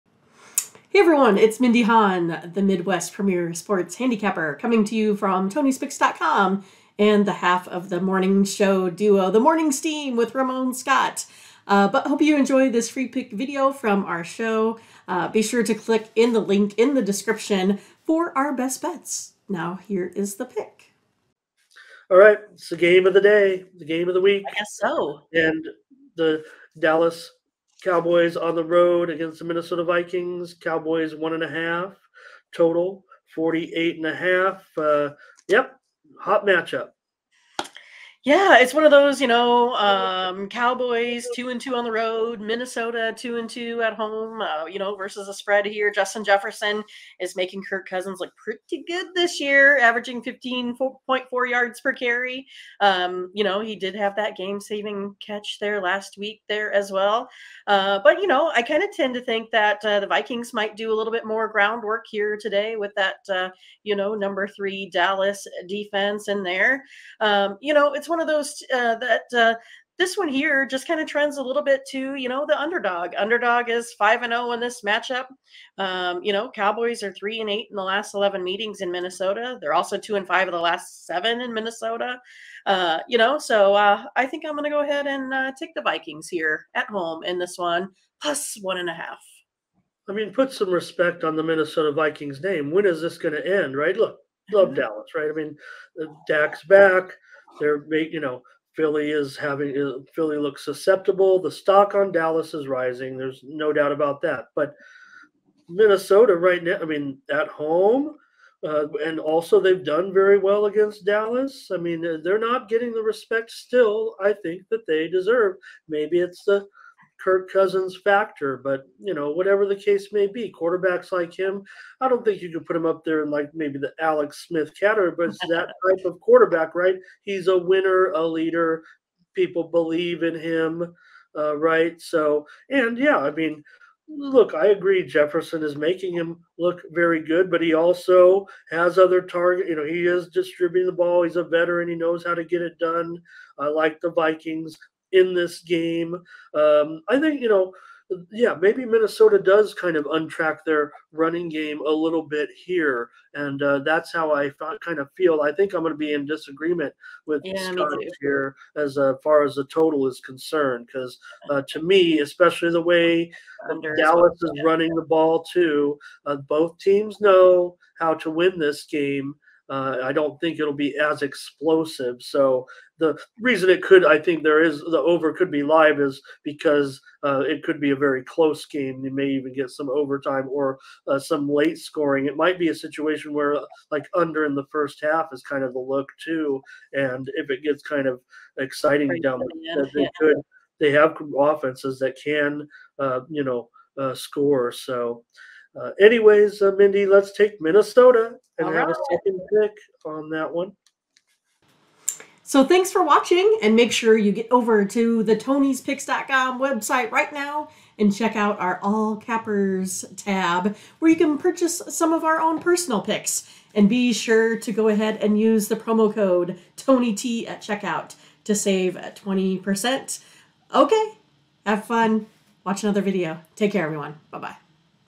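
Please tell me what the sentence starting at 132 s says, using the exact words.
So, and yeah, I mean, look, I agree.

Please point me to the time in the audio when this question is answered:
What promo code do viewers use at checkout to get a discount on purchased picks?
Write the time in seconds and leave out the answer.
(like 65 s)
216 s.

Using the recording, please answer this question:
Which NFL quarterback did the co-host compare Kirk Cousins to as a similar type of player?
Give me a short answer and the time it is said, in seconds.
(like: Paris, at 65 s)
Alex Smith, at 123 s.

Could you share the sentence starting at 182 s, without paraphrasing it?
It might be a situation where like under in the first half is kind of the look too.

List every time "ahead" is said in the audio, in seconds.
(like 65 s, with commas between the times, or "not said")
84 s, 214 s.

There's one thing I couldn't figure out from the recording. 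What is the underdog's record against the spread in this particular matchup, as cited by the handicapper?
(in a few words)
5-0.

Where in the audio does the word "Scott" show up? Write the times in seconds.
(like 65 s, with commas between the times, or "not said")
10 s, 157 s.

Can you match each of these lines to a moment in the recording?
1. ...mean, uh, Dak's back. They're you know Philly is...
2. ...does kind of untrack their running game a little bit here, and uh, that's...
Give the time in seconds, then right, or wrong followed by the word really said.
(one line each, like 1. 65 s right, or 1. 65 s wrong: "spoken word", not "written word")
1. 95 s right
2. 149 s right.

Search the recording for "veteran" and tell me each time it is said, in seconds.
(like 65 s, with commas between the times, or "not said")
141 s.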